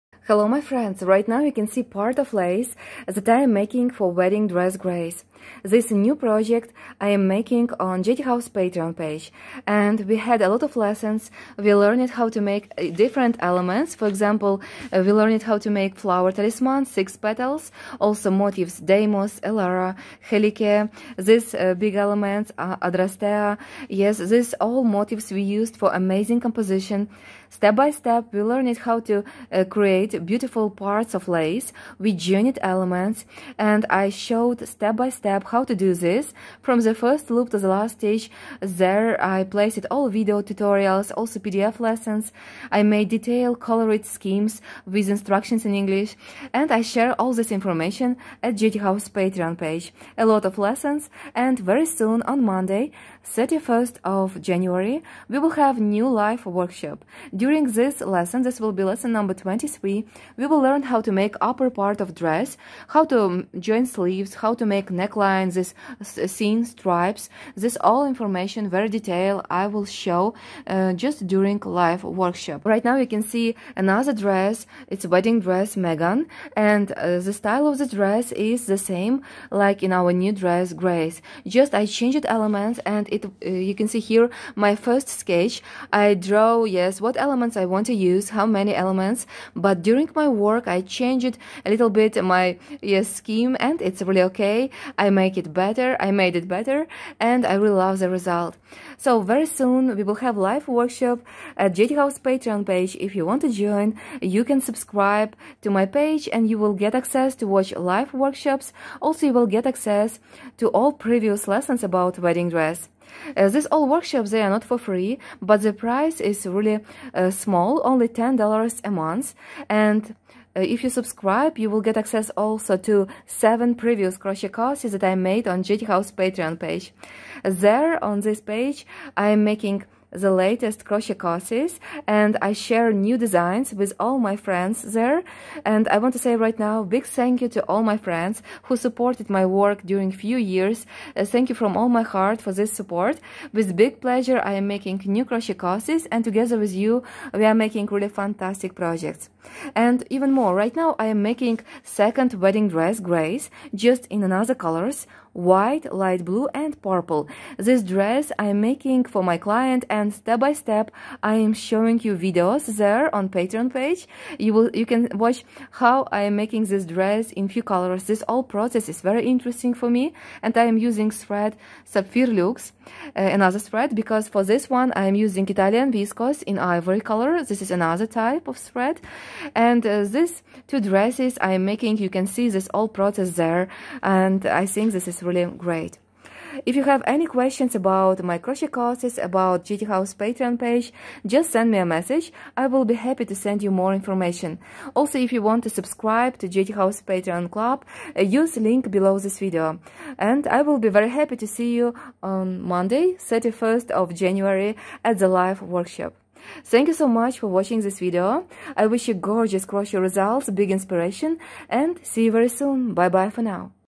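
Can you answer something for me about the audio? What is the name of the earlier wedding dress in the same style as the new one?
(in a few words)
Megan.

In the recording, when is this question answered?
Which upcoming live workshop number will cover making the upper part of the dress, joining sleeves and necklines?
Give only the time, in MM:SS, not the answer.
00:58.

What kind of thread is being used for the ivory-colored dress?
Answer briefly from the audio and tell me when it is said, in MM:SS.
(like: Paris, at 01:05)
Italian viscose, at 02:55.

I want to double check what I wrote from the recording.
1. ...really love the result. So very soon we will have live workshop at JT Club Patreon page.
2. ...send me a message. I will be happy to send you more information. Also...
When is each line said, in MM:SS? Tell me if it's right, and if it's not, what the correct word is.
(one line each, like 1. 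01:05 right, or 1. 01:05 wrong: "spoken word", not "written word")
1. 01:37 wrong: "House", not "Club"
2. 03:11 right.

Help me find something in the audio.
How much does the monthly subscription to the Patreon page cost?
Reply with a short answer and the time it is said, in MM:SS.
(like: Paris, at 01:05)
$10, at 01:58.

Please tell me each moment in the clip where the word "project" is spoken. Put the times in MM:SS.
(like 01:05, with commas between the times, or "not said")
00:06, 02:28.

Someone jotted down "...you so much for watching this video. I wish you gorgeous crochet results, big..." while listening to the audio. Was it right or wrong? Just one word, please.
right.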